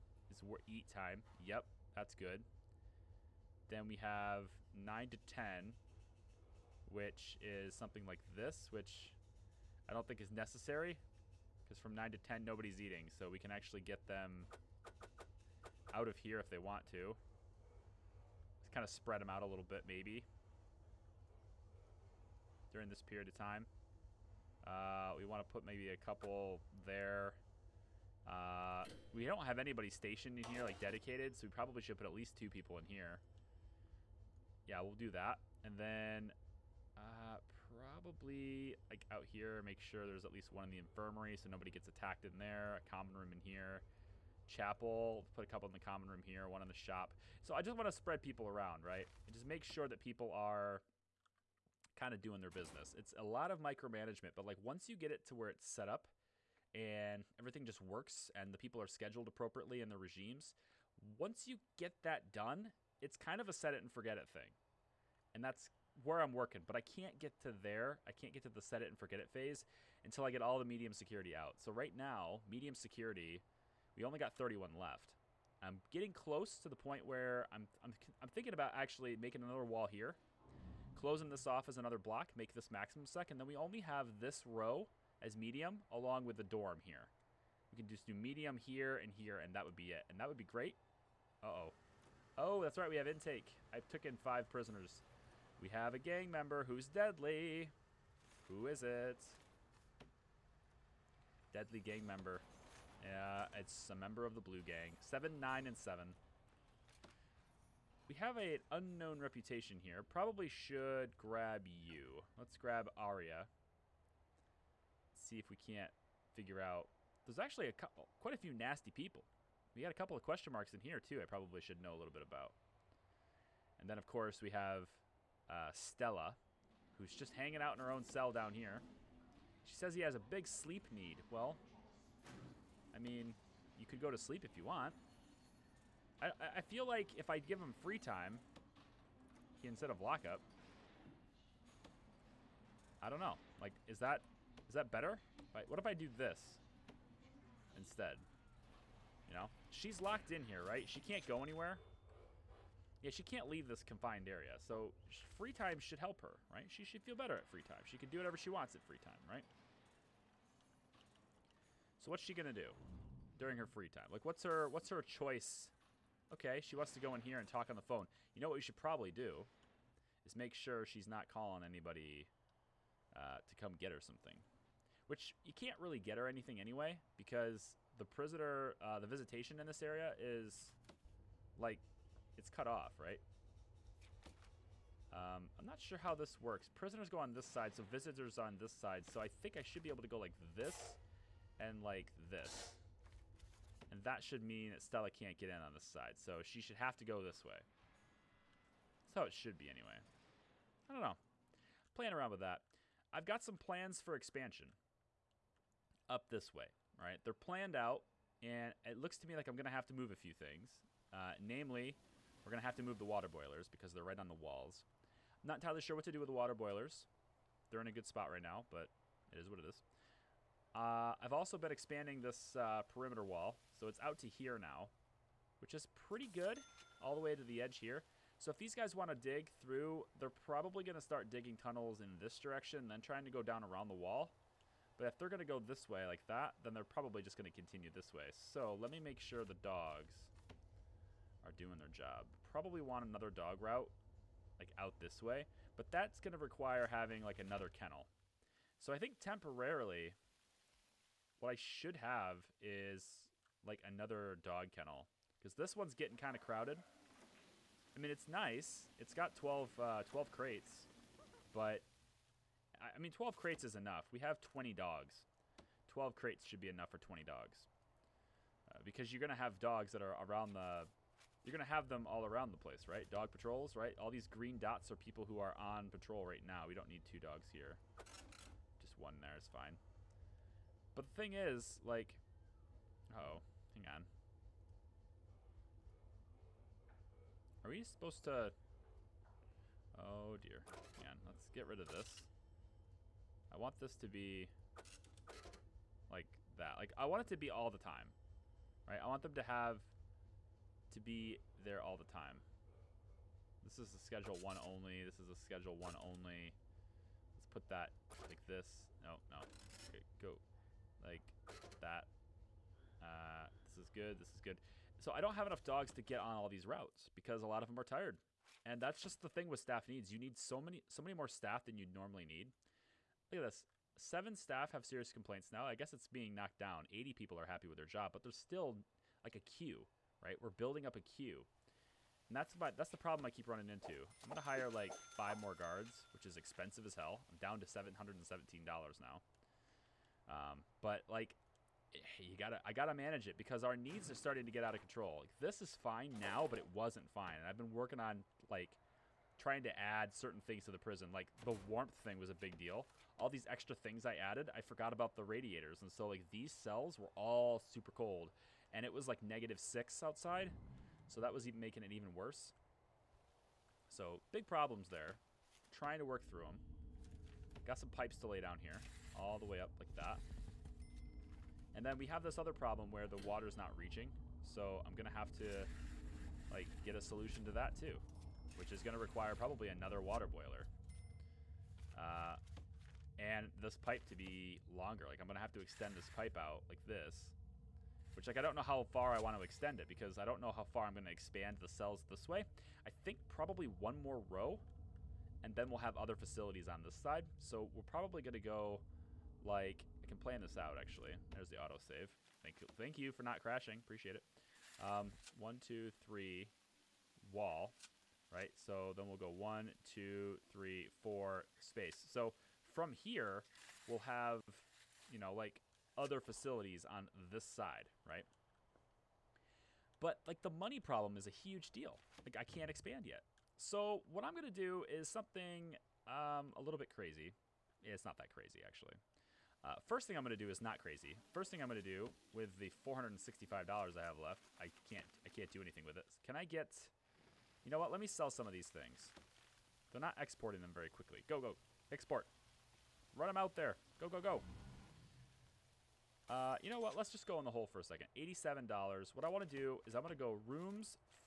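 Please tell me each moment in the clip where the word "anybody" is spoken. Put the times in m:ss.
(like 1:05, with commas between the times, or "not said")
0:29, 2:51.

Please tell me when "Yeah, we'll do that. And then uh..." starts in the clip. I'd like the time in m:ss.
0:34.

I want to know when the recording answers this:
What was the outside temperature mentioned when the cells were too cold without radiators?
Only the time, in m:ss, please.
5:59.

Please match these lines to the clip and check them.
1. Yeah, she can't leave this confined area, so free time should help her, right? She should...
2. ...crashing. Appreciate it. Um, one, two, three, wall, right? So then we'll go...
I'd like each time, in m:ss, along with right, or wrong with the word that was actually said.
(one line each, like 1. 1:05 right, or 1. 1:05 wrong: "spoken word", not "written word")
1. 2:33 right
2. 6:43 right.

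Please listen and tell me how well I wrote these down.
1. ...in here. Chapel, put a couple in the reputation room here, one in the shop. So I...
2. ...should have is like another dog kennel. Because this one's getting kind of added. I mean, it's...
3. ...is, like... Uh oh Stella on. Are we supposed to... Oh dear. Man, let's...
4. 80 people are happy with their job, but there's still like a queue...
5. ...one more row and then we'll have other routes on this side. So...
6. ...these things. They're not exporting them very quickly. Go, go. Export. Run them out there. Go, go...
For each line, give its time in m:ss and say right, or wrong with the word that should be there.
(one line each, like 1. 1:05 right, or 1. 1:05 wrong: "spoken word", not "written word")
1. 0:43 wrong: "common", not "reputation"
2. 4:11 wrong: "crowded", not "added"
3. 4:41 wrong: "Hang", not "Stella"
4. 5:26 right
5. 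6:33 wrong: "facilities", not "routes"
6. 7:18 right.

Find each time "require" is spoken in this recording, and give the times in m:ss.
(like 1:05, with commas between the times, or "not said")
4:06, 6:18.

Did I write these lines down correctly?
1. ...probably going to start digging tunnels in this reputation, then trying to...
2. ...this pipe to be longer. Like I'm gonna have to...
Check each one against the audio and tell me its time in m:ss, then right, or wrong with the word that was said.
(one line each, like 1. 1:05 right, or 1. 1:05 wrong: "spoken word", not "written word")
1. 3:50 wrong: "direction", not "reputation"
2. 6:23 right.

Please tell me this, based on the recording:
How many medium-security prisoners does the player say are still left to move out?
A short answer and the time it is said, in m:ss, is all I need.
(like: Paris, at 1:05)
31, at 1:14.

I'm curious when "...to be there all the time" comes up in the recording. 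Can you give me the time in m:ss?
5:00.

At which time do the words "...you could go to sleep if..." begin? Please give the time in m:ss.
2:13.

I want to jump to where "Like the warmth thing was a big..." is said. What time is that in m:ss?
5:51.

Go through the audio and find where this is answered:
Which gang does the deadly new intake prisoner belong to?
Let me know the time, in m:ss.
1:44.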